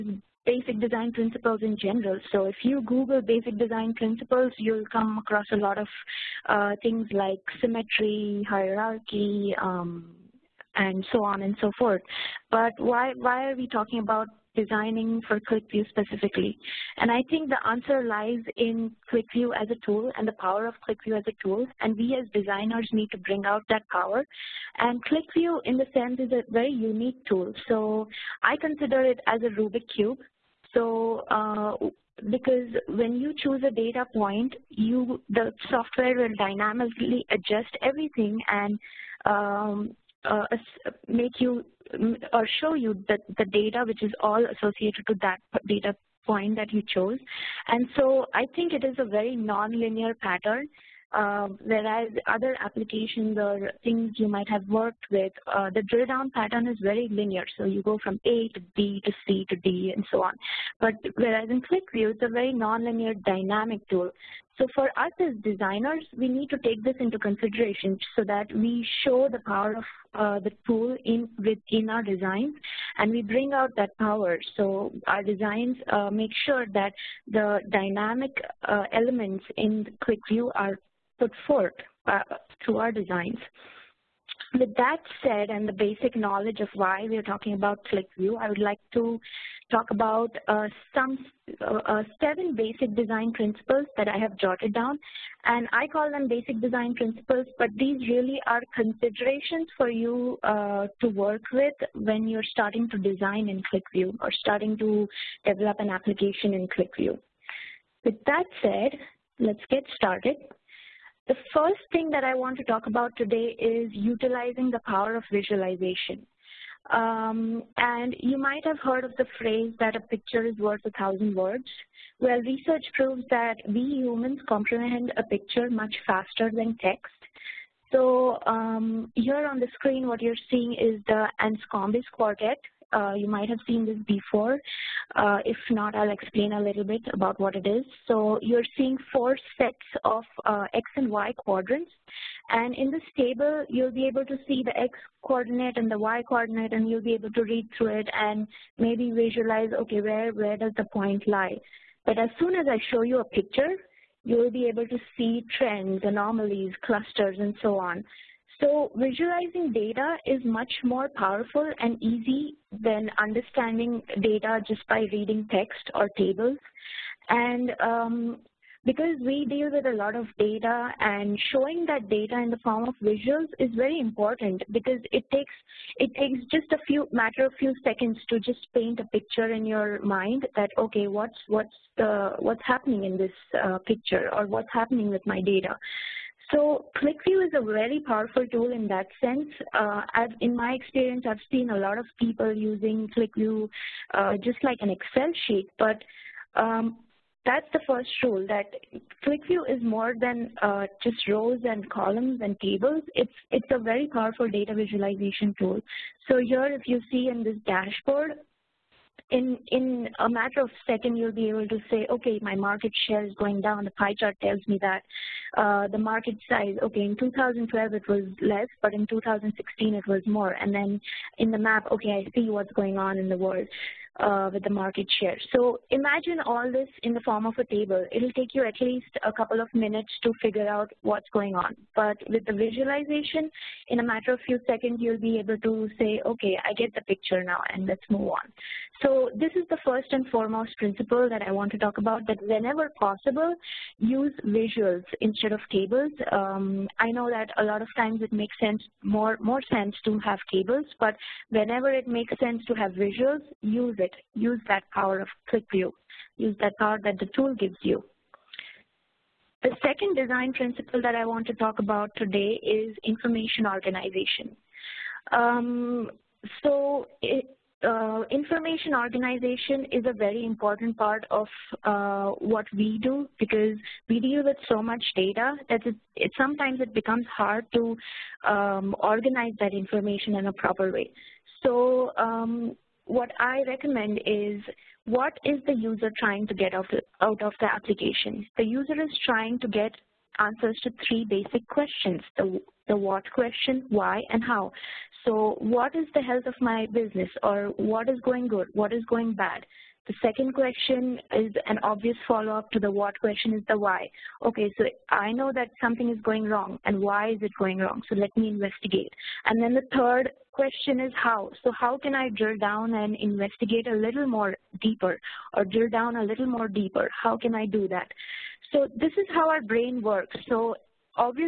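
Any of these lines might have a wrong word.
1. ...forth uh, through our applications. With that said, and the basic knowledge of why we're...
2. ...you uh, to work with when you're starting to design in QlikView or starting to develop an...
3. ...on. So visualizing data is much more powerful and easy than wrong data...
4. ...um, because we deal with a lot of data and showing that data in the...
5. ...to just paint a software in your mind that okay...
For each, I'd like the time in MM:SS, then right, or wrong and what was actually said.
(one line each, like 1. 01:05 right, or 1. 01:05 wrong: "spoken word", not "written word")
1. 01:21 wrong: "designs", not "applications"
2. 01:39 right
3. 02:37 wrong: "understanding", not "wrong"
4. 02:47 right
5. 02:58 wrong: "picture", not "software".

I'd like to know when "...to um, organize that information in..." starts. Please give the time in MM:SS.
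04:37.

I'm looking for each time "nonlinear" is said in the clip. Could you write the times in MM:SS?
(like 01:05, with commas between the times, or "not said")
00:49, 01:02.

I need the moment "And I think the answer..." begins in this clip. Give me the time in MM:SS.
00:16.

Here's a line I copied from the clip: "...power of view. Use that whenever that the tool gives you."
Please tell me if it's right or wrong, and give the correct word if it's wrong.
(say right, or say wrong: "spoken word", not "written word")
wrong: "power", not "whenever".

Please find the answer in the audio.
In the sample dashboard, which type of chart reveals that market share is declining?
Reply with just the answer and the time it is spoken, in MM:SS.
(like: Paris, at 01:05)
pie chart, at 03:33.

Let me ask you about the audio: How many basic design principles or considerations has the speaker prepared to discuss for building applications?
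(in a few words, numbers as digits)
7.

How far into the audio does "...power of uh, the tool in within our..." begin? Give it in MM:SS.
01:09.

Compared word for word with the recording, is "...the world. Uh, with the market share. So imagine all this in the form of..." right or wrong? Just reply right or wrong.
right.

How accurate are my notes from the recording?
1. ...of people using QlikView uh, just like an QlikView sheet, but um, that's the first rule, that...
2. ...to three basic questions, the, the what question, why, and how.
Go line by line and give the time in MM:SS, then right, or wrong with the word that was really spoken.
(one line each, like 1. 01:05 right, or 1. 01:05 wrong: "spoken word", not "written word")
1. 03:11 wrong: "Excel", not "QlikView"
2. 04:50 right.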